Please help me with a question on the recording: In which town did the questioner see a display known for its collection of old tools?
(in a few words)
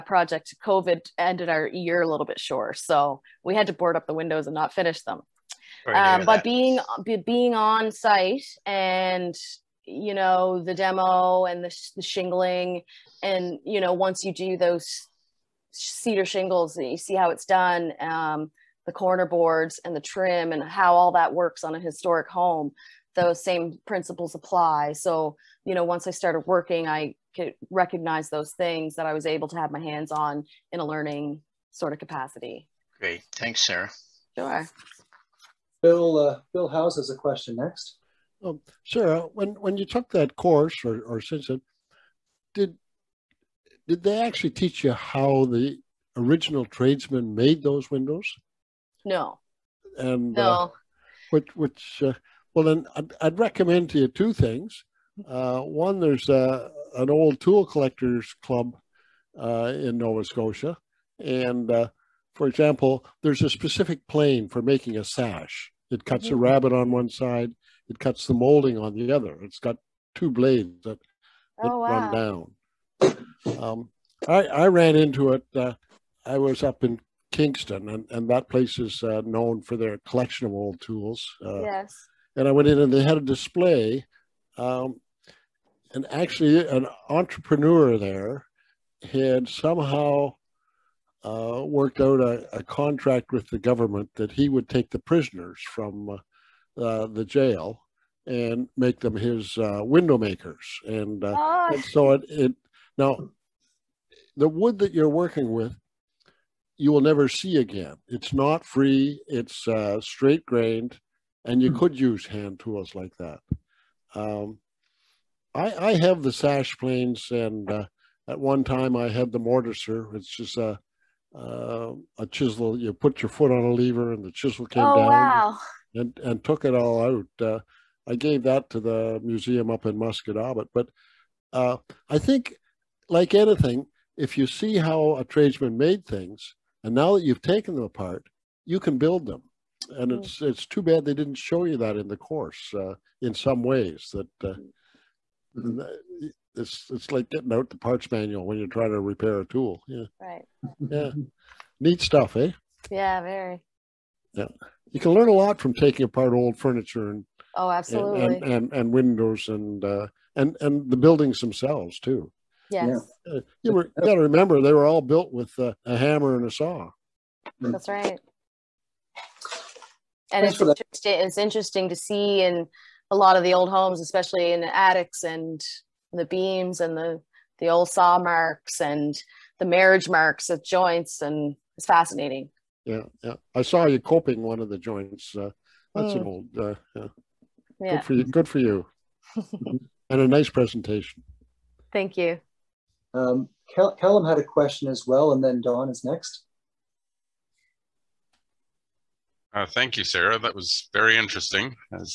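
Kingston.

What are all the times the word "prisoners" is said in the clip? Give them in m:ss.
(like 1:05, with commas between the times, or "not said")
1:34.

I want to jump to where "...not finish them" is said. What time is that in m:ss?
0:04.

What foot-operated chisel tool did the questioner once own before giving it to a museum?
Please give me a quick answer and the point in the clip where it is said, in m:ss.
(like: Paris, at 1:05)
the mortiser, at 1:59.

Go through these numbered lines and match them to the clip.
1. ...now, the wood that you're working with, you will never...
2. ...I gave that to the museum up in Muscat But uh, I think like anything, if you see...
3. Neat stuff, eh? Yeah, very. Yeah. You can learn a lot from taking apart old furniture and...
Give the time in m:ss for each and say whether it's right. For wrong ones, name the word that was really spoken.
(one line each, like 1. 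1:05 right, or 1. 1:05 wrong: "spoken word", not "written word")
1. 1:42 right
2. 2:08 right
3. 2:31 right.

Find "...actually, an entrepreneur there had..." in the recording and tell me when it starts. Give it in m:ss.
1:26.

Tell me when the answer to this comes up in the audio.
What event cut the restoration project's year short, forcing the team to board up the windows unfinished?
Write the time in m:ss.
0:00.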